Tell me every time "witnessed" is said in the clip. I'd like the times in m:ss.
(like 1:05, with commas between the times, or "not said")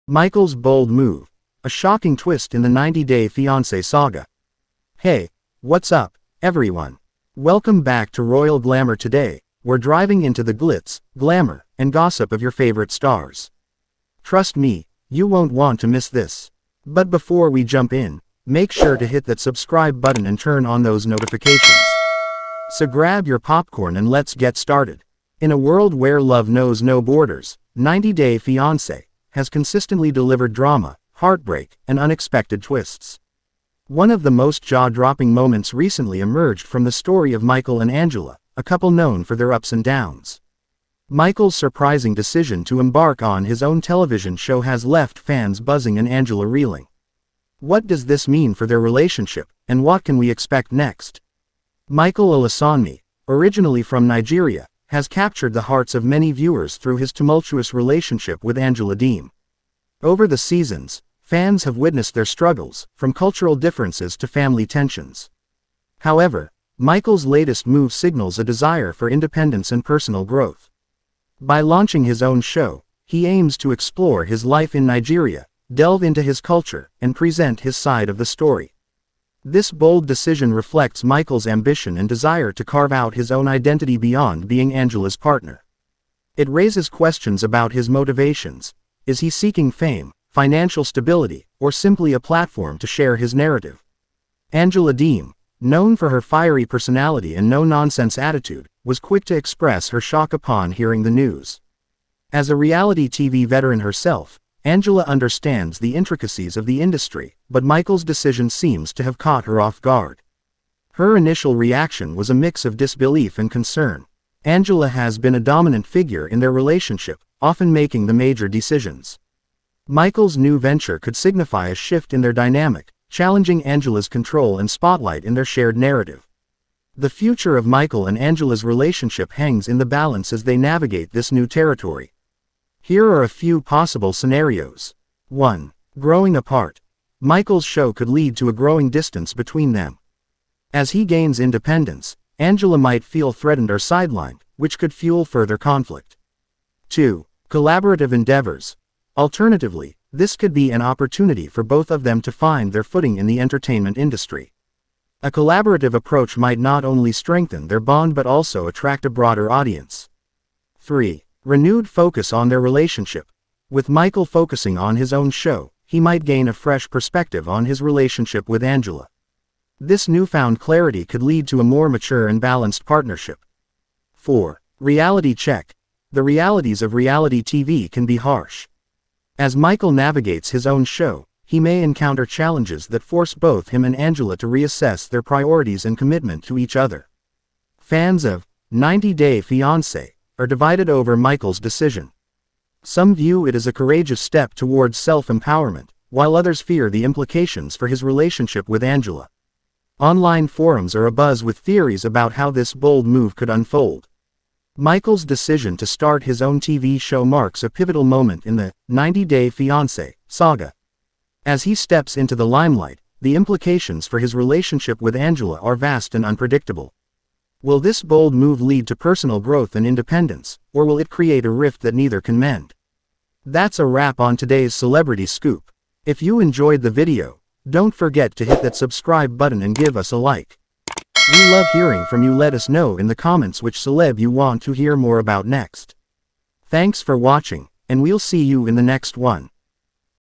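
1:01.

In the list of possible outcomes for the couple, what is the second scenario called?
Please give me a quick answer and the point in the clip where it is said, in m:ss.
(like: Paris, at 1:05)
Collaborative endeavors, at 2:27.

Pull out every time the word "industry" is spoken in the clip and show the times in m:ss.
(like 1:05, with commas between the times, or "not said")
1:46, 2:33.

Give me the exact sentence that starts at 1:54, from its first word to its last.
Angela has been a dominant figure in their relationship, often making the major decisions.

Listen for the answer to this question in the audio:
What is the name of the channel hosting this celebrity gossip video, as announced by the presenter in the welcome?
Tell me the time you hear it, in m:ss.
0:08.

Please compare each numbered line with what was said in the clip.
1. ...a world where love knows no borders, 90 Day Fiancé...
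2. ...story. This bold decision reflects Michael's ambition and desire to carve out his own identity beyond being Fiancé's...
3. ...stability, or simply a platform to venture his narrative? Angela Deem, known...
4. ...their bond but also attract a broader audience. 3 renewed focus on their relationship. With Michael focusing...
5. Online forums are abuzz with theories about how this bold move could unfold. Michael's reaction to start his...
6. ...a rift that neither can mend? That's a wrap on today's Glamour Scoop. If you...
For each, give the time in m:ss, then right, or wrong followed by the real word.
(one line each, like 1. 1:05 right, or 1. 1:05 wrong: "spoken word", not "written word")
1. 0:25 right
2. 1:18 wrong: "Angela", not "Fiancé"
3. 1:30 wrong: "share", not "venture"
4. 2:37 right
5. 3:19 wrong: "decision", not "reaction"
6. 3:41 wrong: "Celebrity", not "Glamour".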